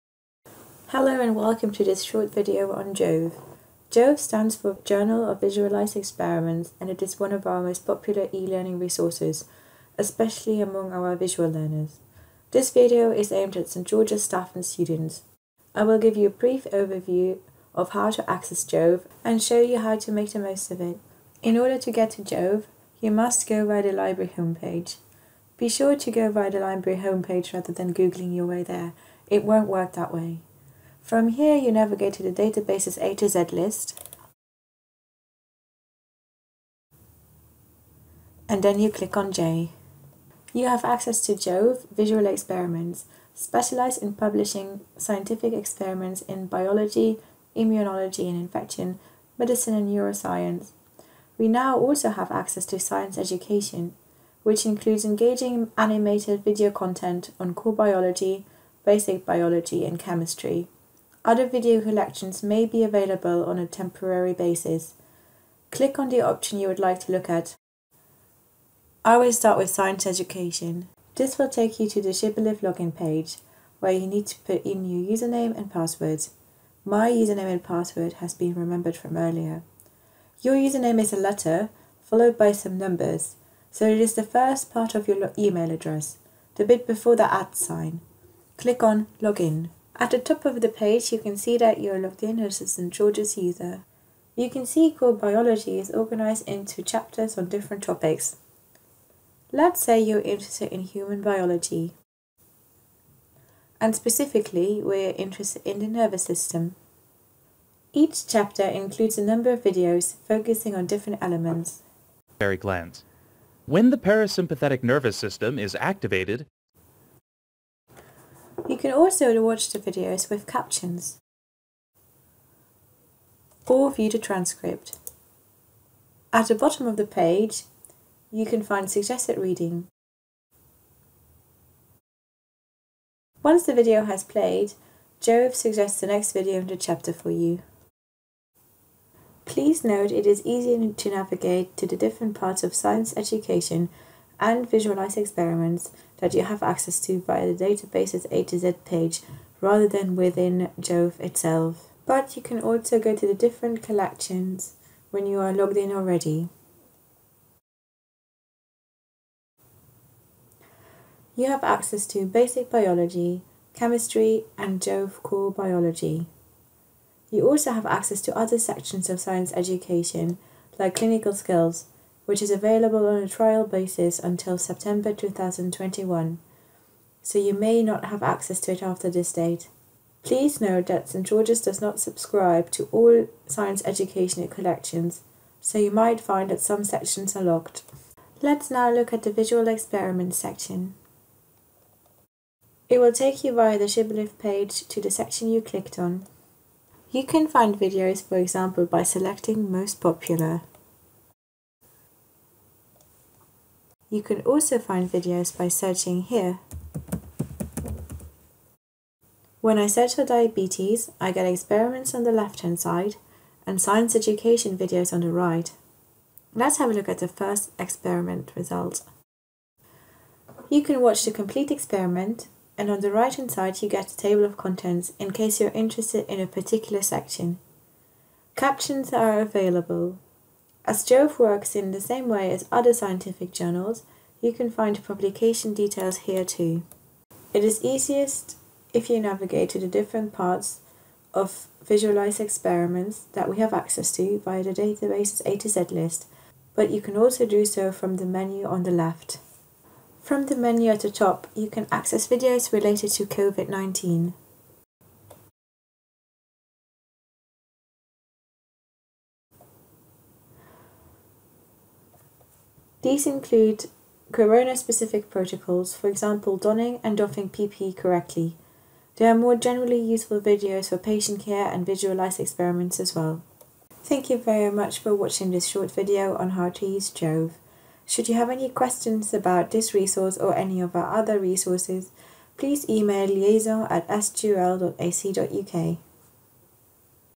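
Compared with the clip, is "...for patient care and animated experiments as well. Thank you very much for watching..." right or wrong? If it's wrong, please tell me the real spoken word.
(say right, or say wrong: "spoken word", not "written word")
wrong: "visualized", not "animated".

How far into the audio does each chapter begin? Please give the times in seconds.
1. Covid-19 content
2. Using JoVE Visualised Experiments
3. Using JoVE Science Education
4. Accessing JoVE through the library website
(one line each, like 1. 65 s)
1. 254 s
2. 188 s
3. 69 s
4. 21 s.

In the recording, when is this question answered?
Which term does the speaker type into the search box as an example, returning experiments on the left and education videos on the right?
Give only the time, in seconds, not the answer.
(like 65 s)
210 s.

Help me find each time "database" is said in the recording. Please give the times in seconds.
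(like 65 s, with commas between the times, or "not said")
32 s, 147 s, 244 s.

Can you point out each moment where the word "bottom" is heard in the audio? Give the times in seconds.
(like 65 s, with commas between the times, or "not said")
126 s.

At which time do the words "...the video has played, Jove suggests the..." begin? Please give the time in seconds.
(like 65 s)
133 s.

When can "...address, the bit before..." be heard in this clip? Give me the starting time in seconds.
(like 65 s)
85 s.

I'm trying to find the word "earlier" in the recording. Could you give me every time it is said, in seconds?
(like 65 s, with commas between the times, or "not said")
79 s.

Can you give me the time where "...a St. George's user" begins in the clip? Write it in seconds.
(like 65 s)
92 s.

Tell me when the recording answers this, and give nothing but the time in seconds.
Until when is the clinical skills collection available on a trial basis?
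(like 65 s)
174 s.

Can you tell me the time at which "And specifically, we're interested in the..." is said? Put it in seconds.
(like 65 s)
103 s.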